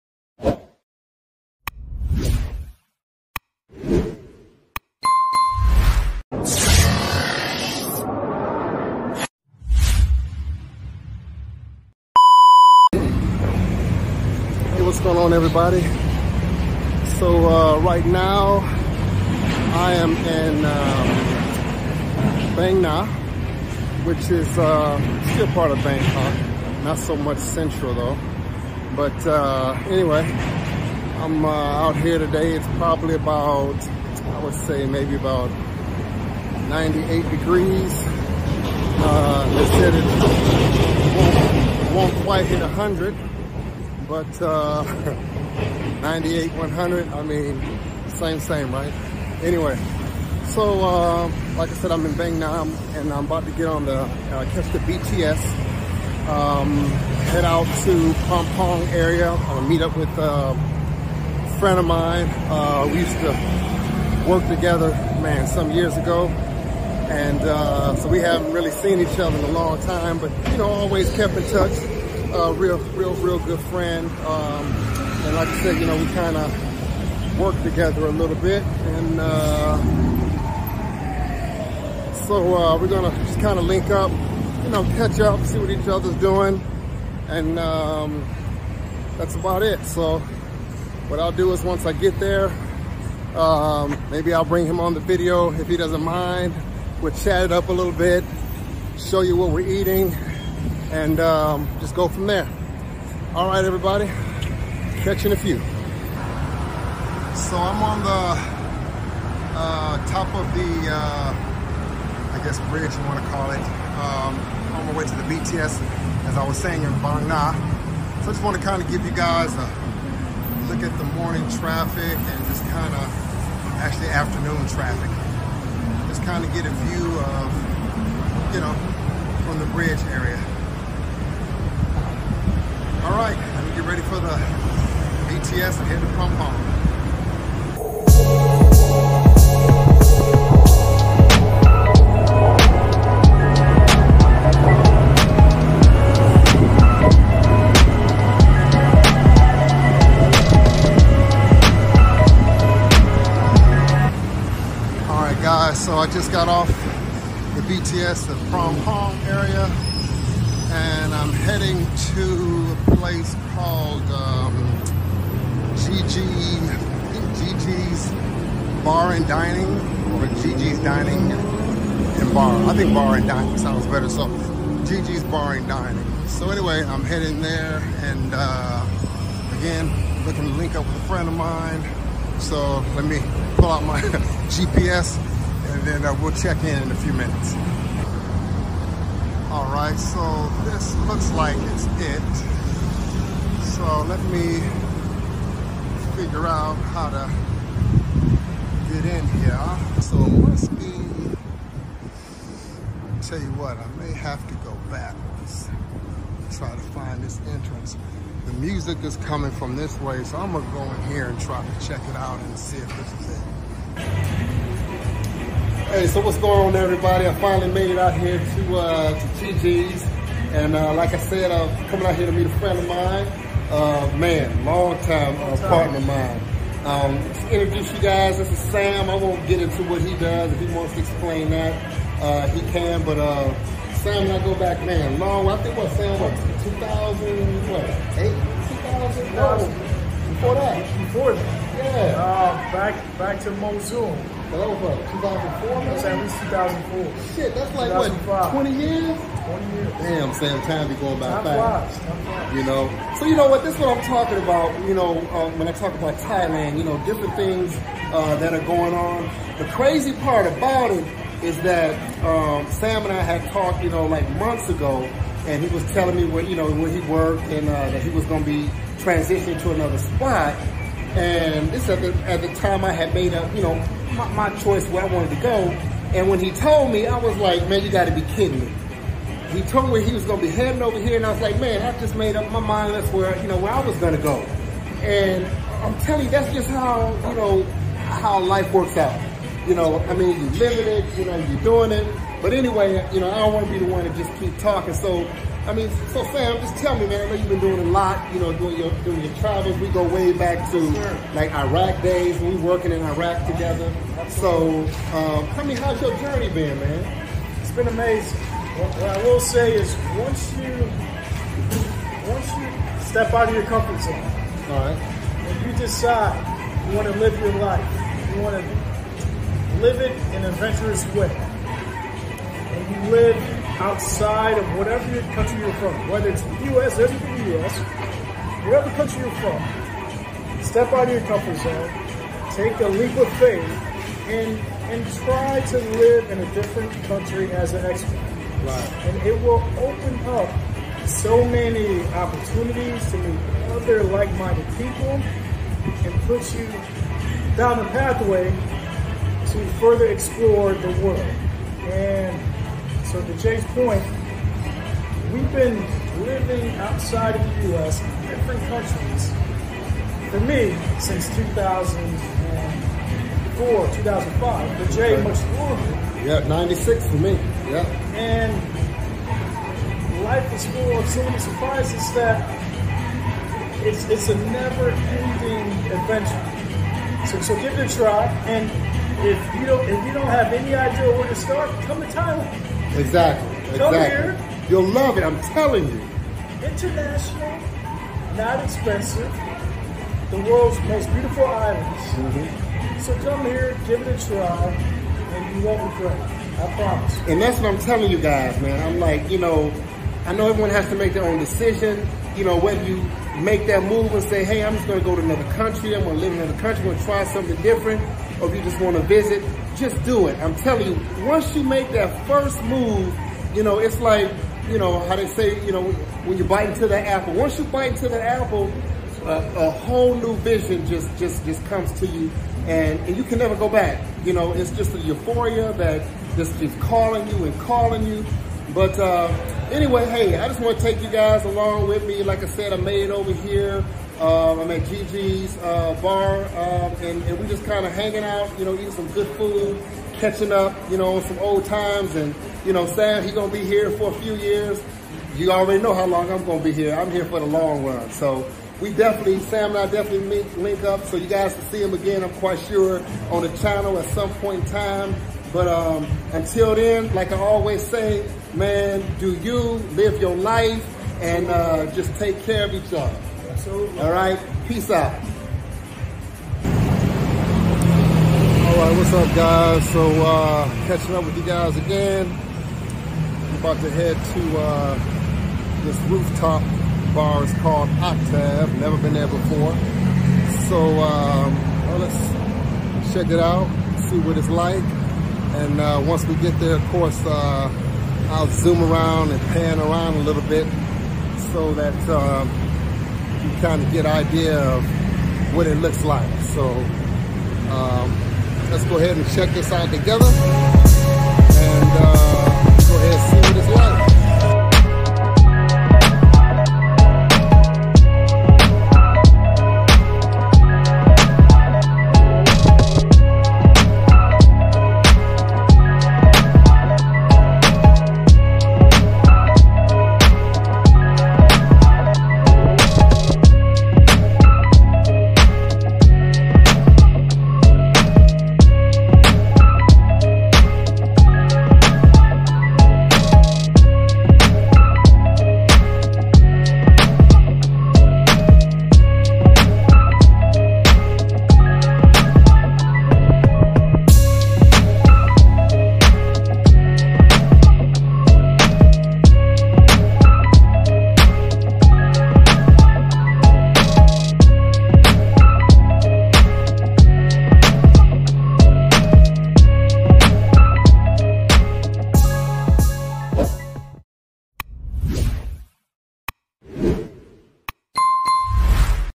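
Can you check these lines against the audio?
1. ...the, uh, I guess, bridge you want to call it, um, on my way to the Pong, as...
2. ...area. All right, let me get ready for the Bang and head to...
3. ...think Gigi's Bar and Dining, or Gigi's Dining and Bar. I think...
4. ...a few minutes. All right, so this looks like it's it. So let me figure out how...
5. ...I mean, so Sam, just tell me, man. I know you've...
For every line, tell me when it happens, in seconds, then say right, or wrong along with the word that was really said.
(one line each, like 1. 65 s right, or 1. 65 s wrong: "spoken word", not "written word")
1. 110 s wrong: "BTS", not "Pong"
2. 130 s wrong: "BTS", not "Bang"
3. 167 s right
4. 186 s right
5. 295 s right.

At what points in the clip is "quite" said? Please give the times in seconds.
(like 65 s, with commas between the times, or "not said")
42 s, 452 s.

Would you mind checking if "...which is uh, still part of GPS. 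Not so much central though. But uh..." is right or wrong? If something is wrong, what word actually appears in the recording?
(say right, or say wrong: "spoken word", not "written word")
wrong: "Bangkok", not "GPS".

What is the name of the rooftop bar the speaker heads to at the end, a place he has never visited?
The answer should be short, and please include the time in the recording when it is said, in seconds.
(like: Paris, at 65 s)
Octave, at 477 s.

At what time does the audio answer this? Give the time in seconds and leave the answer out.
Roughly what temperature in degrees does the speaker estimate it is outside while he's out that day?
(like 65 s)
36 s.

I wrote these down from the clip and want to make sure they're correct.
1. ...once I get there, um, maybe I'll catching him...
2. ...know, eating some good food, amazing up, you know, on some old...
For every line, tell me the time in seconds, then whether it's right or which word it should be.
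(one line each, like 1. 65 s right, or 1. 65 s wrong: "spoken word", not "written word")
1. 91 s wrong: "bring", not "catching"
2. 438 s wrong: "catching", not "amazing".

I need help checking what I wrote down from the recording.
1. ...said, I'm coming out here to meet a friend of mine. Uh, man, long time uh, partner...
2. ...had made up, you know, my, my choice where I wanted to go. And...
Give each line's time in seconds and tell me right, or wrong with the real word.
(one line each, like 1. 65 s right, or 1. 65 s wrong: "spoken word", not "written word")
1. 221 s right
2. 272 s right.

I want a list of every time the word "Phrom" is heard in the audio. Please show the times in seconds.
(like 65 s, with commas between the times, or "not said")
58 s, 136 s.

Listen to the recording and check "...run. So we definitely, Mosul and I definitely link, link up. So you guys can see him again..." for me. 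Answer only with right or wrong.
wrong.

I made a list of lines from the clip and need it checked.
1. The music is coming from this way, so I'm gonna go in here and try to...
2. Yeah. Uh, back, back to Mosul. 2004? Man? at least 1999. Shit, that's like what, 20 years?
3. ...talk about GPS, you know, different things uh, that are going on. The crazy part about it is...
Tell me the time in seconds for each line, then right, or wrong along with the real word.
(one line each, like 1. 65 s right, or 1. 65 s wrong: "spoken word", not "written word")
1. 208 s right
2. 241 s wrong: "2004", not "1999"
3. 255 s wrong: "Thailand", not "GPS".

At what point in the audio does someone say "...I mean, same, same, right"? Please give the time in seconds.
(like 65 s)
47 s.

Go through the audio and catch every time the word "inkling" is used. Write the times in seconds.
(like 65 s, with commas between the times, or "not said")
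not said.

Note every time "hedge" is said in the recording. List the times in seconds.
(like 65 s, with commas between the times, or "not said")
not said.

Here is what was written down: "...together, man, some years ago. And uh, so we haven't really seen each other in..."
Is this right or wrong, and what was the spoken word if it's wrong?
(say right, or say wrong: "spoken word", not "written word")
right.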